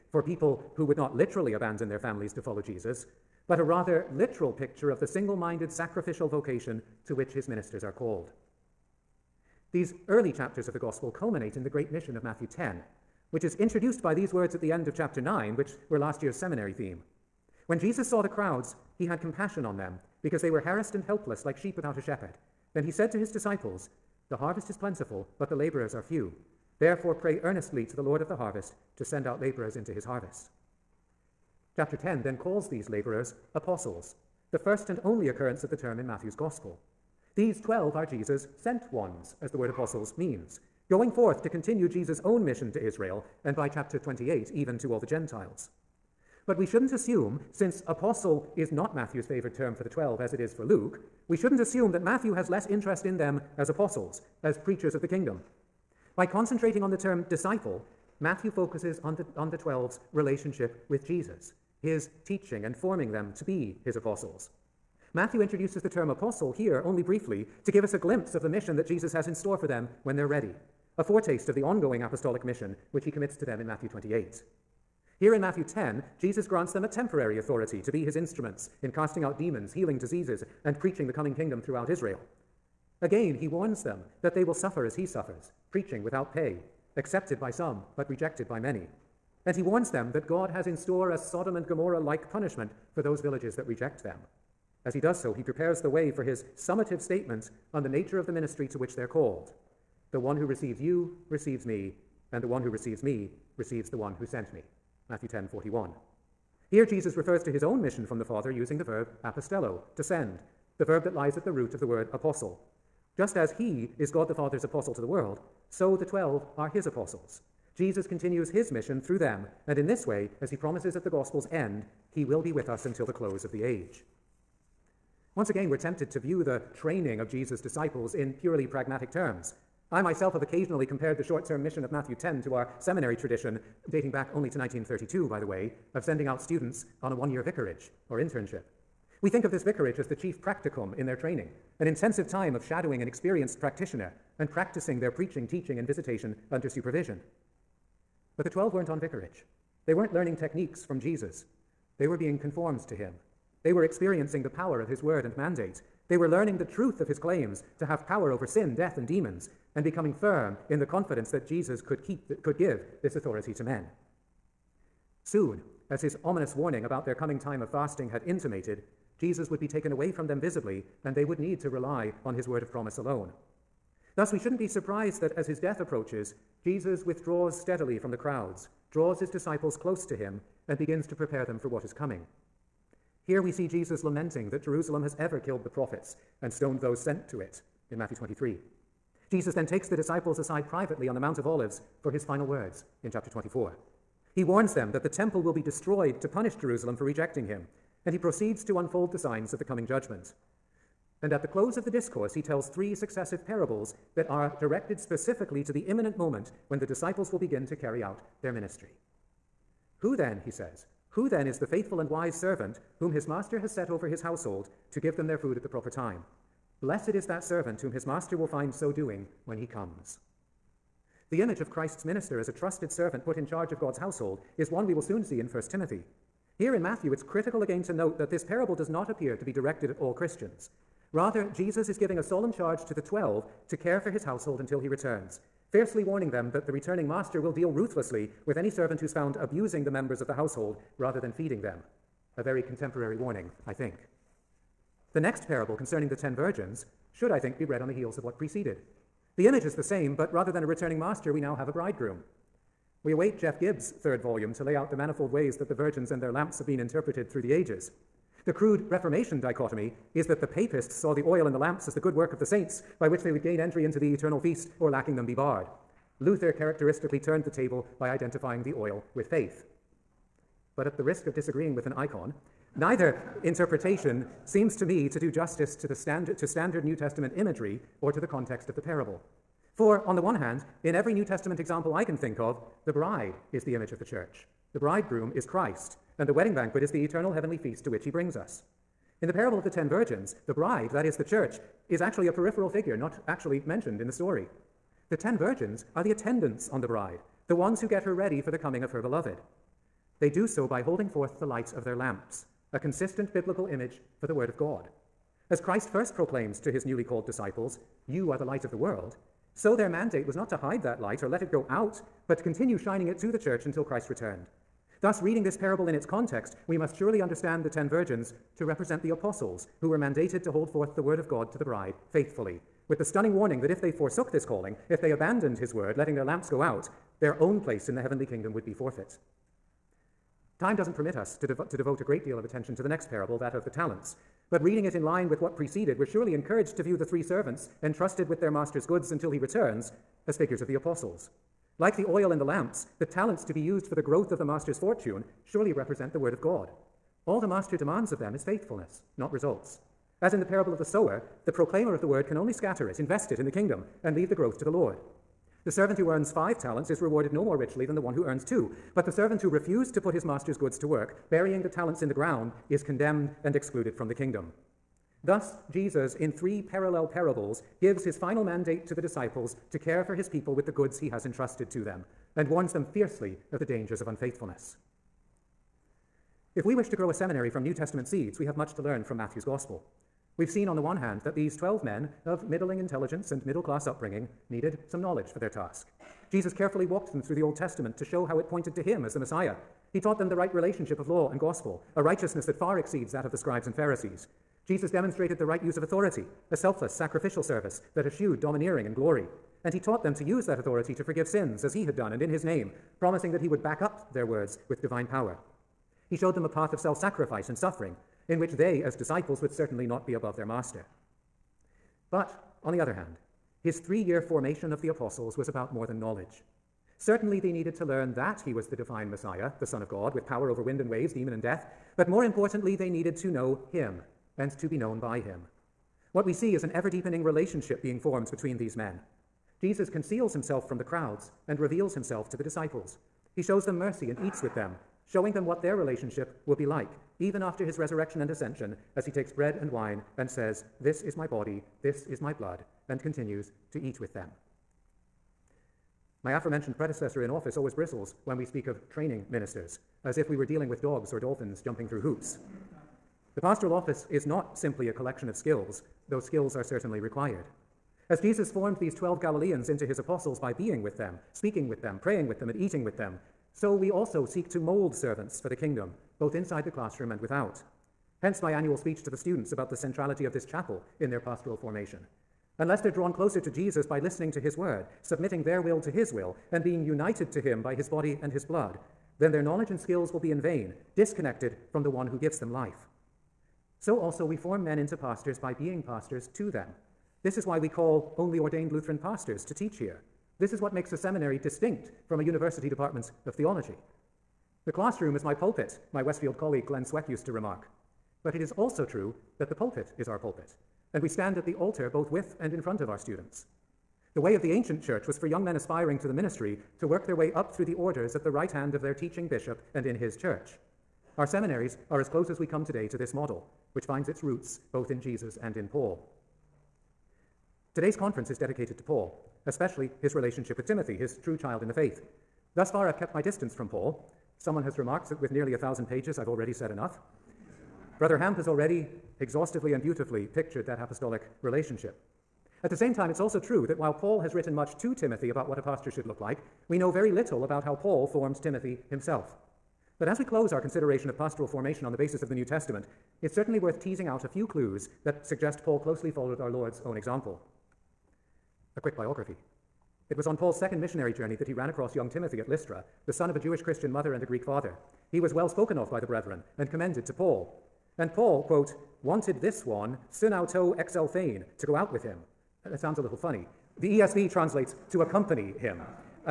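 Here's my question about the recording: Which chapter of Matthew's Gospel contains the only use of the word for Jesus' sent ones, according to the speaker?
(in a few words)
Chapter 10.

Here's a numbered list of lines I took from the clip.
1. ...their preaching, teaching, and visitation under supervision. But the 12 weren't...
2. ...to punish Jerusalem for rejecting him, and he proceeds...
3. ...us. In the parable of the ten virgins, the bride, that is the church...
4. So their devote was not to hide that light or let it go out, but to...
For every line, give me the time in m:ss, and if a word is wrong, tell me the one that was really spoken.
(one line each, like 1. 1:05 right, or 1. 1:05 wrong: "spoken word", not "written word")
1. 2:24 right
2. 3:16 right
3. 4:48 right
4. 5:09 wrong: "mandate", not "devote".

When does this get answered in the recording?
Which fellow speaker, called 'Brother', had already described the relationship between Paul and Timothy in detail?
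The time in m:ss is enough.
8:47.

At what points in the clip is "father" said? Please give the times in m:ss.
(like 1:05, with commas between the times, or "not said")
1:48, 1:54, 9:14.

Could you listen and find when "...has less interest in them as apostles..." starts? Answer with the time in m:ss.
0:52.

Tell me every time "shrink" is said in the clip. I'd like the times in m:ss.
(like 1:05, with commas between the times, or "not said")
not said.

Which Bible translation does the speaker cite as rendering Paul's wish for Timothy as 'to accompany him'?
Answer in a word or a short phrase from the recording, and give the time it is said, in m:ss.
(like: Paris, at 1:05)
ESV, at 9:23.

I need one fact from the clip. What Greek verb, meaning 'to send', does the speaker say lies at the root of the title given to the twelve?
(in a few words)
apostello.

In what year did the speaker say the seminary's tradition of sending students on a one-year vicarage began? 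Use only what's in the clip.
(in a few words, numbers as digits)
1932.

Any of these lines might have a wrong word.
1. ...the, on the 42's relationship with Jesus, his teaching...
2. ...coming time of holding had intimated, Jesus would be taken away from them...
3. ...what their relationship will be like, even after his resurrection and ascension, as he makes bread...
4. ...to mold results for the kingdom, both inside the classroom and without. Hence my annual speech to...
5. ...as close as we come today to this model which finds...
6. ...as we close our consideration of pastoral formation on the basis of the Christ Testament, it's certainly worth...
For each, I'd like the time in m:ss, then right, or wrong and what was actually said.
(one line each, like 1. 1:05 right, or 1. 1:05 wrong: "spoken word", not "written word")
1. 0:59 wrong: "12", not "42"
2. 2:47 wrong: "fasting", not "holding"
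3. 7:15 wrong: "takes", not "makes"
4. 7:44 wrong: "servants", not "results"
5. 8:31 right
6. 9:00 wrong: "New", not "Christ".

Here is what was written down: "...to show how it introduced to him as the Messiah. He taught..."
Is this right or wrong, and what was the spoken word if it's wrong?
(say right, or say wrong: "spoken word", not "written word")
wrong: "pointed", not "introduced".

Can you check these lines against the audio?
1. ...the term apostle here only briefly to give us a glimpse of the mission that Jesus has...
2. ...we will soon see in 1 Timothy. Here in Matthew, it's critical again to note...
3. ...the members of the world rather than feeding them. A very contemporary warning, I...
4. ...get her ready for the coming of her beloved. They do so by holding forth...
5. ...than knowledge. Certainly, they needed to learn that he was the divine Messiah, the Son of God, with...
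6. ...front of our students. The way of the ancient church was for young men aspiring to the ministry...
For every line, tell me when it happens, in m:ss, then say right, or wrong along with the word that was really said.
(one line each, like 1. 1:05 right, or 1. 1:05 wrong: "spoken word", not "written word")
1. 1:05 right
2. 3:44 right
3. 3:59 wrong: "household", not "world"
4. 4:57 right
5. 6:55 right
6. 8:22 right.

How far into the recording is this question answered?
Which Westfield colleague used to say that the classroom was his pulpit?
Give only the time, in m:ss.
8:16.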